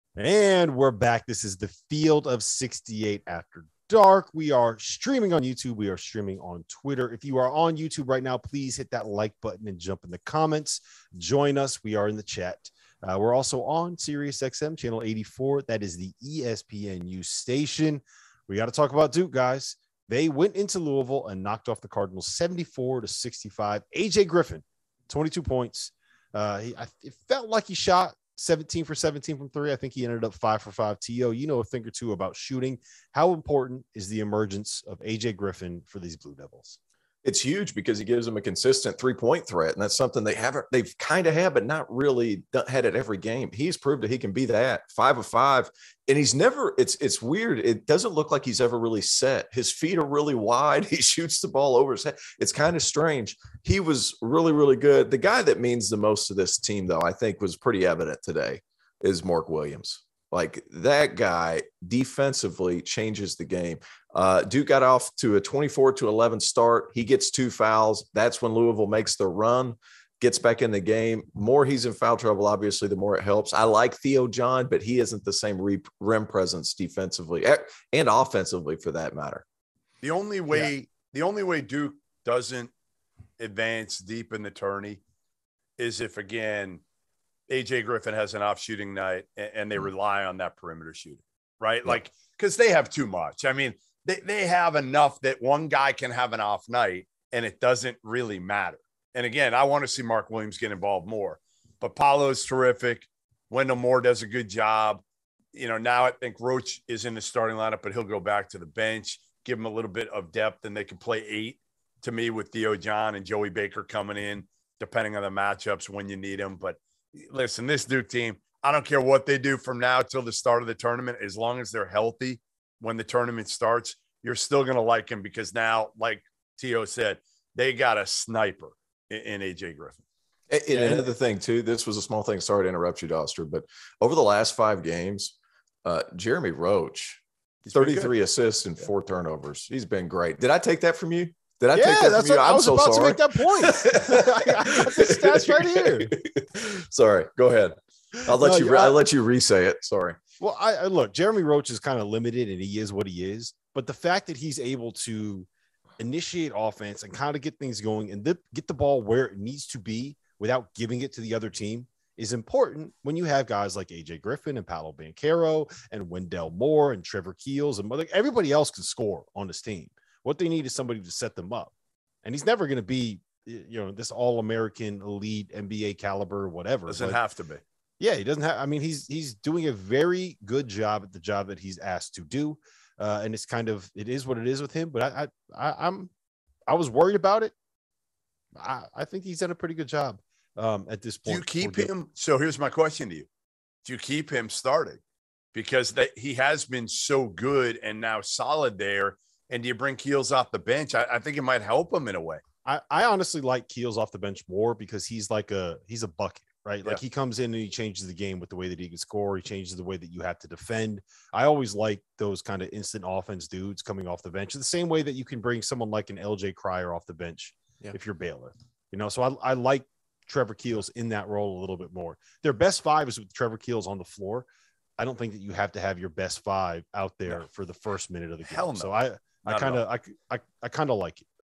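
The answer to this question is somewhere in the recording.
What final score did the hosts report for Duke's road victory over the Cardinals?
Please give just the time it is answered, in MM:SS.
00:22.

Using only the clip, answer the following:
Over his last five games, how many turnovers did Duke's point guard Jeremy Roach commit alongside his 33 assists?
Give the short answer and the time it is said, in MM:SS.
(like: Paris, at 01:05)
4, at 02:18.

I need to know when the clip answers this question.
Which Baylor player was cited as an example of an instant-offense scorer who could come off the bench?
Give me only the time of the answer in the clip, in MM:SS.
03:36.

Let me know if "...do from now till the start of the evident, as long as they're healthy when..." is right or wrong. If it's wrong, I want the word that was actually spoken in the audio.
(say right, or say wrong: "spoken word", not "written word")
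wrong: "tournament", not "evident".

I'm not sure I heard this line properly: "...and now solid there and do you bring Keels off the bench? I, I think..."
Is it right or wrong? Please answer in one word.
right.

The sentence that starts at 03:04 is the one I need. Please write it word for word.
But I, I, I am I was worried about it.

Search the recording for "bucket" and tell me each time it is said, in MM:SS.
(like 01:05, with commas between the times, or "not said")
03:26.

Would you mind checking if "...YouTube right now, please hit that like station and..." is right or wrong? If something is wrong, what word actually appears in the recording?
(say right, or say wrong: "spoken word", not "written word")
wrong: "button", not "station".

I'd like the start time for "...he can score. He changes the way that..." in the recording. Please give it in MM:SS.
03:28.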